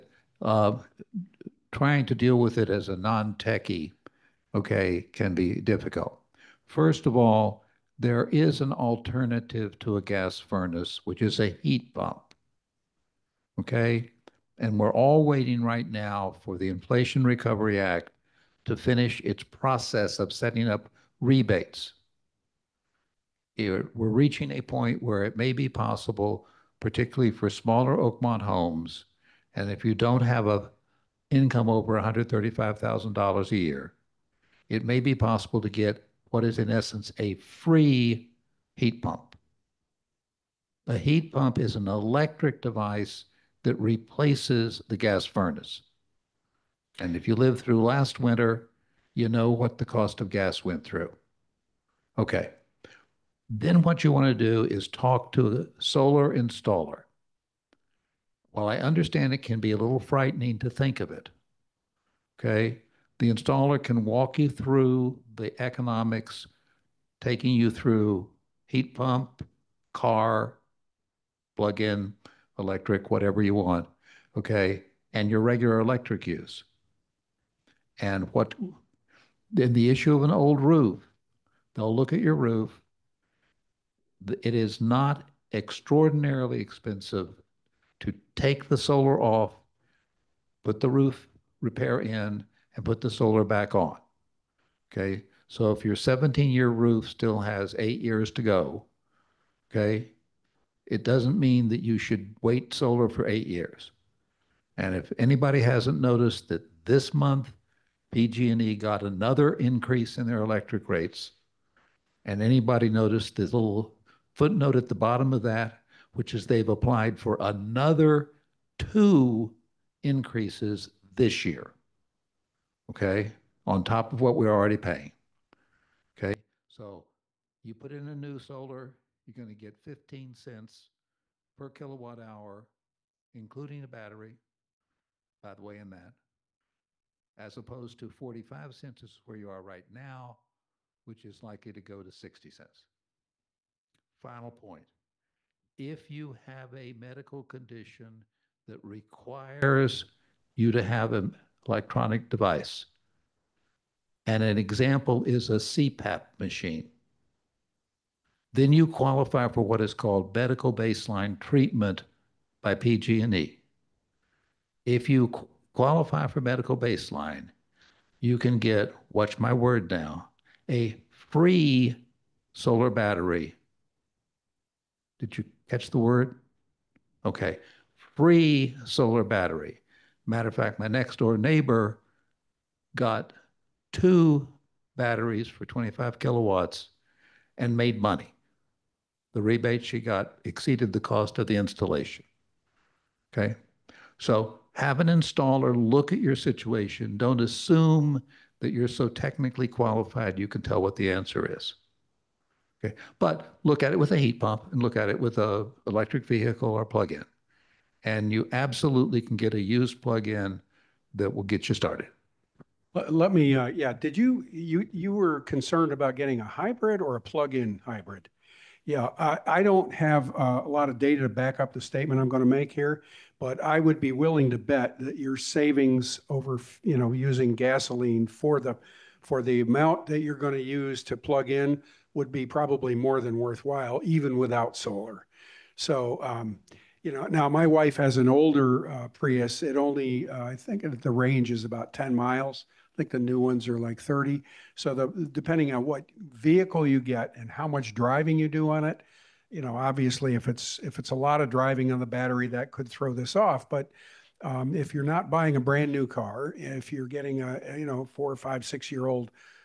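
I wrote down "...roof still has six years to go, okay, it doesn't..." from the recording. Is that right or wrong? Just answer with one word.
wrong.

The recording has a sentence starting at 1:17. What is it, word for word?
And what, then the issue of an old roof, they'll look at your roof.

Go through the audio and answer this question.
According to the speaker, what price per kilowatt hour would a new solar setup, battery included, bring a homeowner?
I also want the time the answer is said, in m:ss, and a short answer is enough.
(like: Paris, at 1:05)
15 cents, at 2:09.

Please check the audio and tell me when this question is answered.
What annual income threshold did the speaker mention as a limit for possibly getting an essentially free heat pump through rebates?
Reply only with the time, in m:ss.
0:31.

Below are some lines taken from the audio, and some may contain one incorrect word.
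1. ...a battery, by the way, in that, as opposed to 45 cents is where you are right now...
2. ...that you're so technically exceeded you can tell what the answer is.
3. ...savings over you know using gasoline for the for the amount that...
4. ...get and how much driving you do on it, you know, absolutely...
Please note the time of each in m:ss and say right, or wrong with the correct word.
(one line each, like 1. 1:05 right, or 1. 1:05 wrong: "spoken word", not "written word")
1. 2:13 right
2. 3:18 wrong: "qualified", not "exceeded"
3. 3:45 right
4. 4:07 wrong: "obviously", not "absolutely".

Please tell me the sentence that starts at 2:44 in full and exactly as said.
If you qualify for medical baseline, you can get, watch my word now, a free solar battery.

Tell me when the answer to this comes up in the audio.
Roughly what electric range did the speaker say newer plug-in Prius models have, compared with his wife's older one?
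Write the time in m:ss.
4:03.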